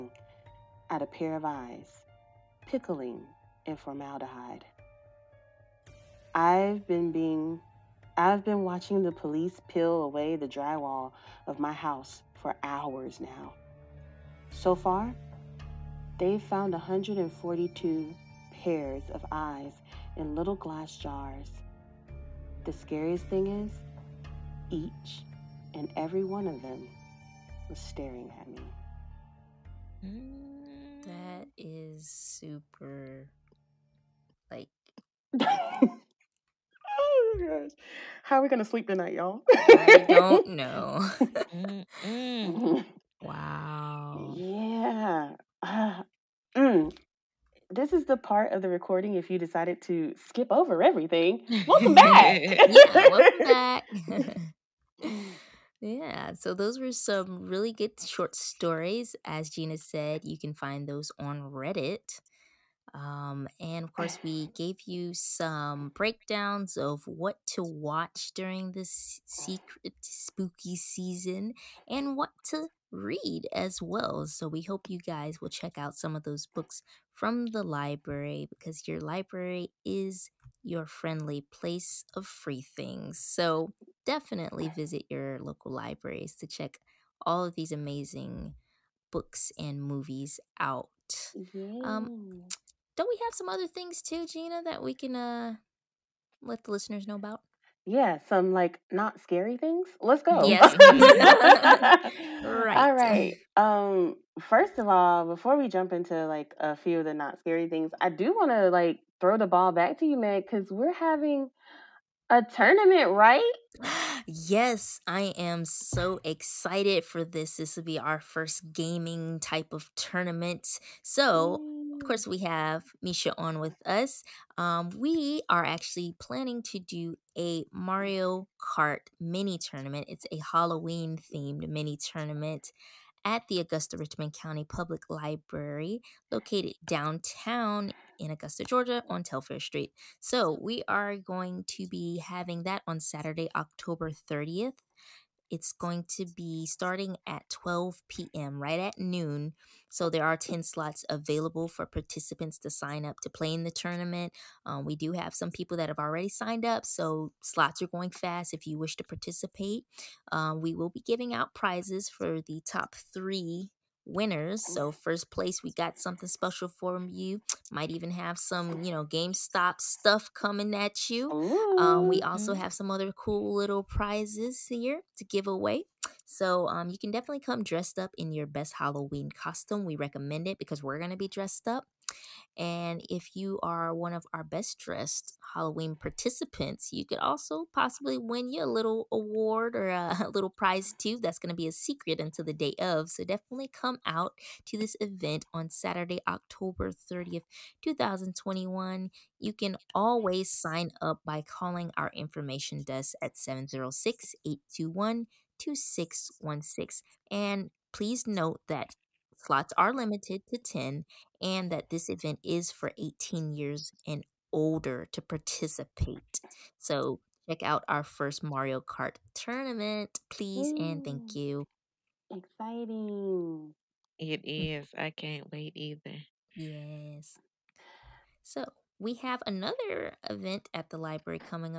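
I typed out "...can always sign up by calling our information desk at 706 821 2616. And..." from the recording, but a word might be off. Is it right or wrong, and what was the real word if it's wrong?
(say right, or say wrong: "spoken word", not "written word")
right.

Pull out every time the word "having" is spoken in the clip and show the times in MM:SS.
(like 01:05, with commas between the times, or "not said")
01:50, 02:22.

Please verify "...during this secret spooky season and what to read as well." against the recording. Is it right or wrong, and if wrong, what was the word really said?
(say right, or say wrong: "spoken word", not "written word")
right.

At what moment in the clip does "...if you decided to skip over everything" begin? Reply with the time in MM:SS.
00:49.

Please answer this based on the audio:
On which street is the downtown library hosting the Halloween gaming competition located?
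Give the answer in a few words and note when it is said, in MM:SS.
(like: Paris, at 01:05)
Telfair Street, at 02:19.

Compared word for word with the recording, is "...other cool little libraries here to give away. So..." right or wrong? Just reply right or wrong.
wrong.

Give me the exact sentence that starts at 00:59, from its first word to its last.
As Gina said, you can find those on Reddit.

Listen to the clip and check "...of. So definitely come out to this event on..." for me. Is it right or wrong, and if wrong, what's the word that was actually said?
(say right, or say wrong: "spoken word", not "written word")
right.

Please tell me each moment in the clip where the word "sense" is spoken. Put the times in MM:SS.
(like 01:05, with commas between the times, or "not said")
not said.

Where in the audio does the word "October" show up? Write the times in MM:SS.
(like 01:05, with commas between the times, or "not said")
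02:23, 03:16.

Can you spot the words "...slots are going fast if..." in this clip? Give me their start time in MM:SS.
02:37.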